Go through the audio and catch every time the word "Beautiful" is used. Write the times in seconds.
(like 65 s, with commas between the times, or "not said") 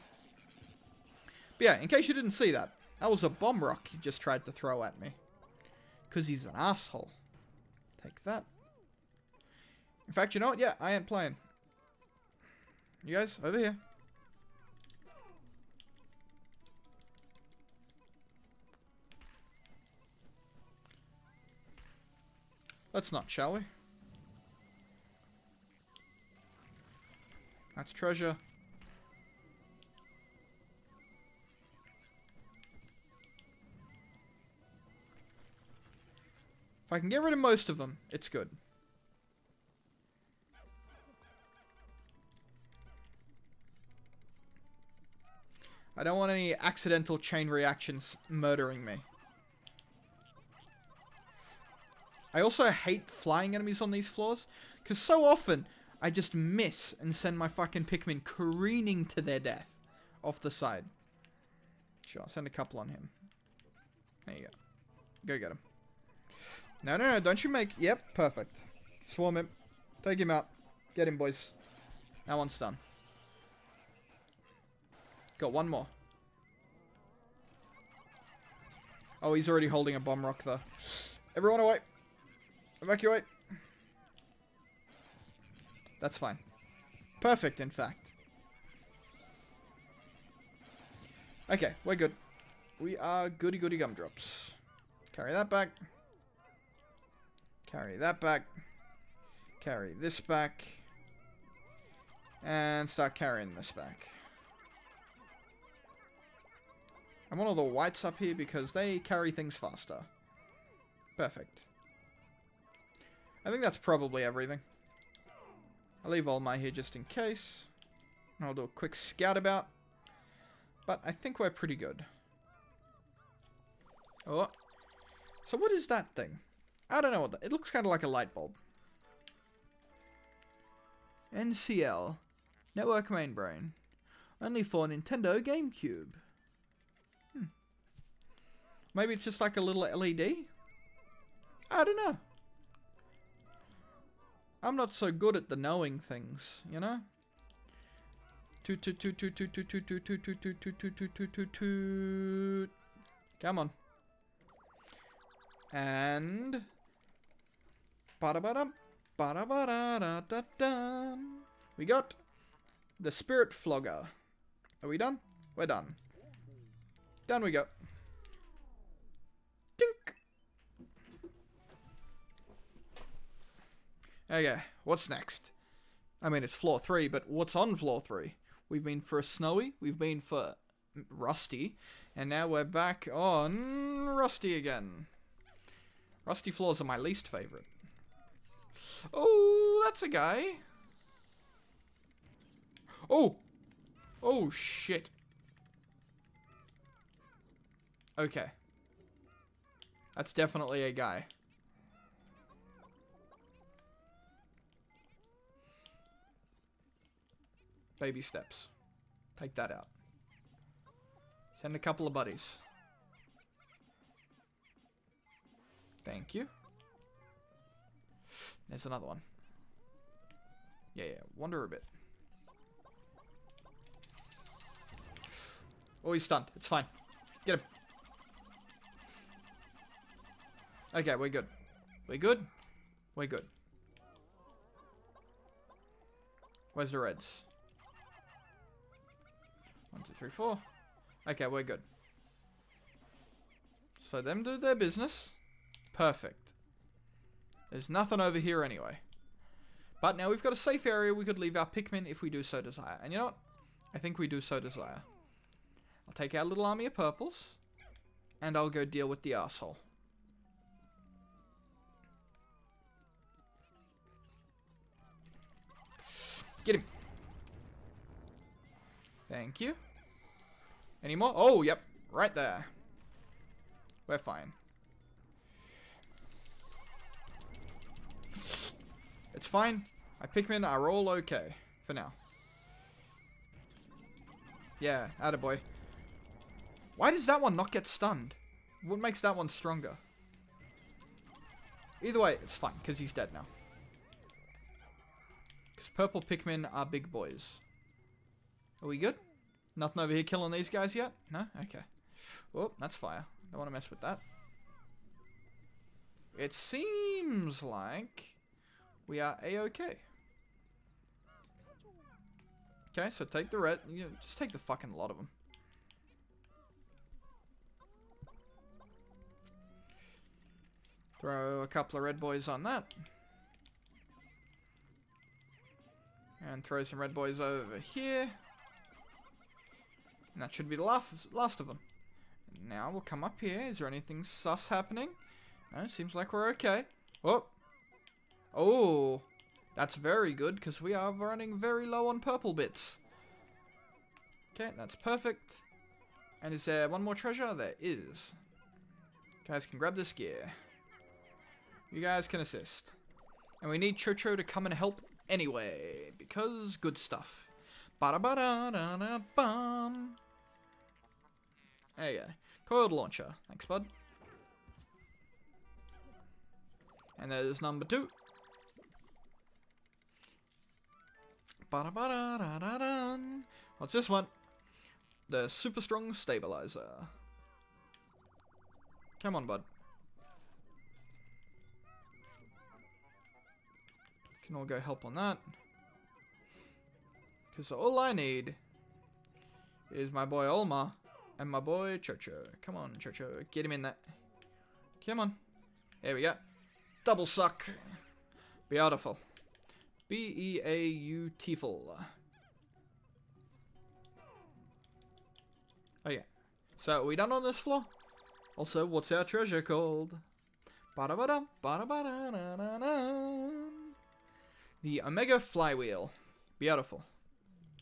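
398 s, 416 s.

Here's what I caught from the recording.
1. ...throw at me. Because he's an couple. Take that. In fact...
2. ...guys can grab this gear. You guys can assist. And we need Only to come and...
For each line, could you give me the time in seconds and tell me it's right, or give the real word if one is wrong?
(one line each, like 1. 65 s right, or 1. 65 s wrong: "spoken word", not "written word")
1. 4 s wrong: "asshole", not "couple"
2. 349 s wrong: "Chocho", not "Only".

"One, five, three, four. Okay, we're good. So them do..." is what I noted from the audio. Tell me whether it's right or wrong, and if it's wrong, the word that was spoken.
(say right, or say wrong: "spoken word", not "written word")
wrong: "two", not "five".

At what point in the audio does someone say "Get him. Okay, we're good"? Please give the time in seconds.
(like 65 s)
227 s.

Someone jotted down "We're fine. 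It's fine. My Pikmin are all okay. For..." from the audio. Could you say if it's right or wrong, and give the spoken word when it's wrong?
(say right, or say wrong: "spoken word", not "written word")
right.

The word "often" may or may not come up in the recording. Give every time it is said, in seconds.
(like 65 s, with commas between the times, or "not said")
55 s.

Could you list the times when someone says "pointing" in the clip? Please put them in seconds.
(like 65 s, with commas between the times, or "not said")
not said.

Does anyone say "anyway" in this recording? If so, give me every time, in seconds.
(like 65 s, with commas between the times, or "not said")
248 s, 355 s.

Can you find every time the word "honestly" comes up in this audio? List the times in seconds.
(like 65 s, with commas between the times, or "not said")
not said.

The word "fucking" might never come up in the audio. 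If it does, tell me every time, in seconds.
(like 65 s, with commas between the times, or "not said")
57 s, 314 s.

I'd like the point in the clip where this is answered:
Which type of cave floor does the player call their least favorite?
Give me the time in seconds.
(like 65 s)
186 s.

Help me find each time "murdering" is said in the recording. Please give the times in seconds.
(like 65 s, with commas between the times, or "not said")
48 s.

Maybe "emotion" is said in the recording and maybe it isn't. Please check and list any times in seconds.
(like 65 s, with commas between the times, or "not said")
not said.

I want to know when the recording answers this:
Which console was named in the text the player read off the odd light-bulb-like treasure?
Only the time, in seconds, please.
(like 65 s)
134 s.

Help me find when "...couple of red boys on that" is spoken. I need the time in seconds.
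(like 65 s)
321 s.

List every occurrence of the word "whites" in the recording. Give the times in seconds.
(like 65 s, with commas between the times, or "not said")
107 s.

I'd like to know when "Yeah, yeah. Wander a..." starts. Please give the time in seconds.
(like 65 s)
220 s.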